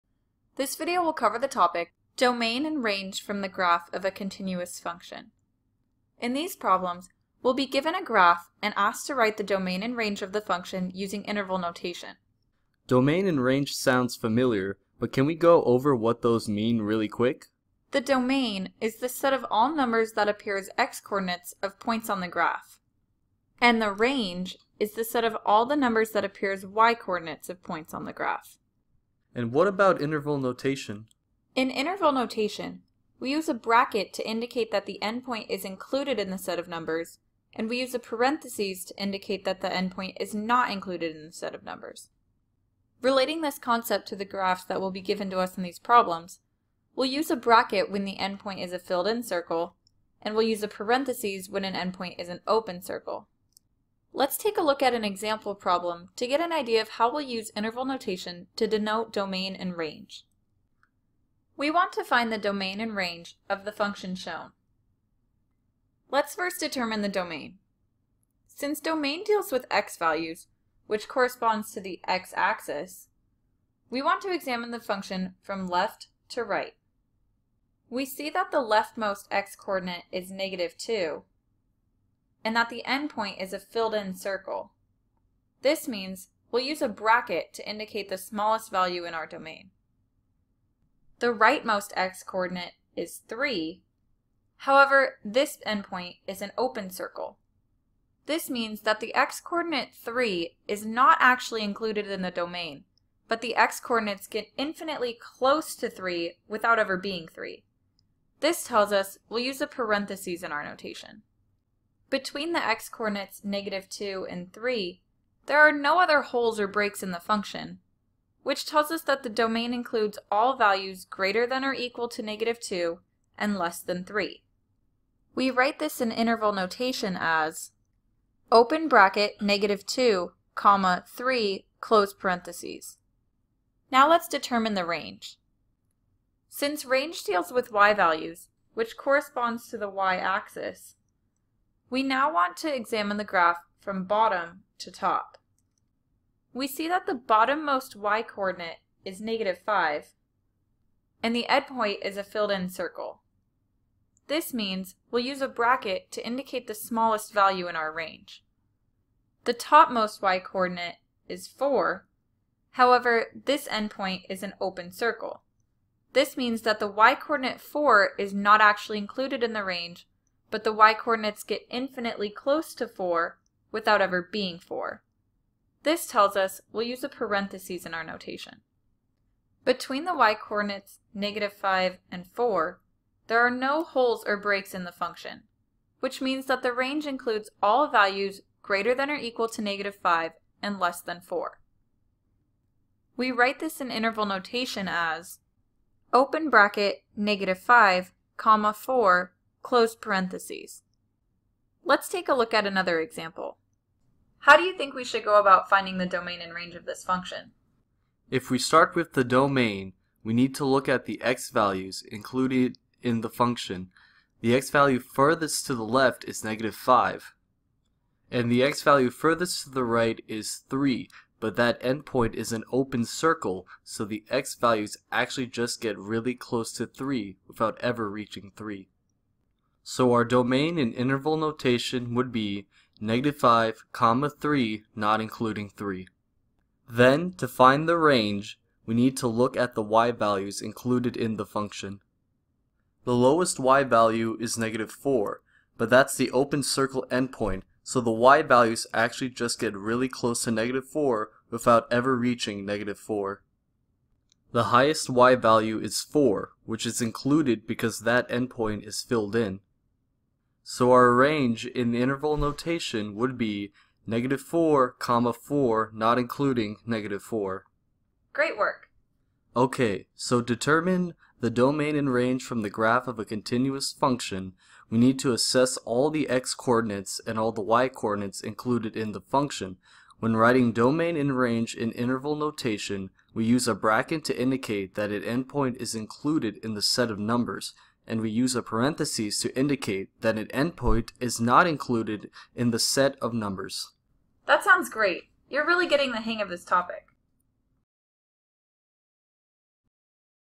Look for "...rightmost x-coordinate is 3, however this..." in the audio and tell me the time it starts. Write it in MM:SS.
01:31.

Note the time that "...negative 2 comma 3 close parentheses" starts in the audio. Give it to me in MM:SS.
02:09.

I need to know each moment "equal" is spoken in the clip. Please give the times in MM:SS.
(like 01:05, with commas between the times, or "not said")
02:01, 03:09.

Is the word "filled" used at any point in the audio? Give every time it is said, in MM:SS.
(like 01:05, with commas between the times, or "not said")
00:48, 01:23, 02:32, 04:19.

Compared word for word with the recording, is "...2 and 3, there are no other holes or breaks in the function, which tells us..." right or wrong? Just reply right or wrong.
right.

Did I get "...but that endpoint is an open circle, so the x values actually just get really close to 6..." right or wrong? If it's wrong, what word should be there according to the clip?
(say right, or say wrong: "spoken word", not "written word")
wrong: "3", not "6".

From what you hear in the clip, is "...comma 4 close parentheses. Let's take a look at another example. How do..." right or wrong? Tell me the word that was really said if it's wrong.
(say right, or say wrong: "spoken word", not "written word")
right.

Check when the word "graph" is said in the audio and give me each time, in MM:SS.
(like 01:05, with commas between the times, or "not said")
00:03, 00:08, 00:22, 00:28, 00:44, 02:23, 04:32.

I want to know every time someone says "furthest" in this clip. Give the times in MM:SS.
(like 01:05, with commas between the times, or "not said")
03:34, 03:39.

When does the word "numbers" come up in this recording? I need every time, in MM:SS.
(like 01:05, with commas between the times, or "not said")
00:19, 00:25, 00:36, 00:41, 04:47, 04:53.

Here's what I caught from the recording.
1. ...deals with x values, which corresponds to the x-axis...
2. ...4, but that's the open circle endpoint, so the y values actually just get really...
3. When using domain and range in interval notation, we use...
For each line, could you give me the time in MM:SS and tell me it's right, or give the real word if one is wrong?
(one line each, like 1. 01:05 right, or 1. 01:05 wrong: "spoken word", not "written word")
1. 01:09 right
2. 04:04 right
3. 04:40 wrong: "writing", not "using".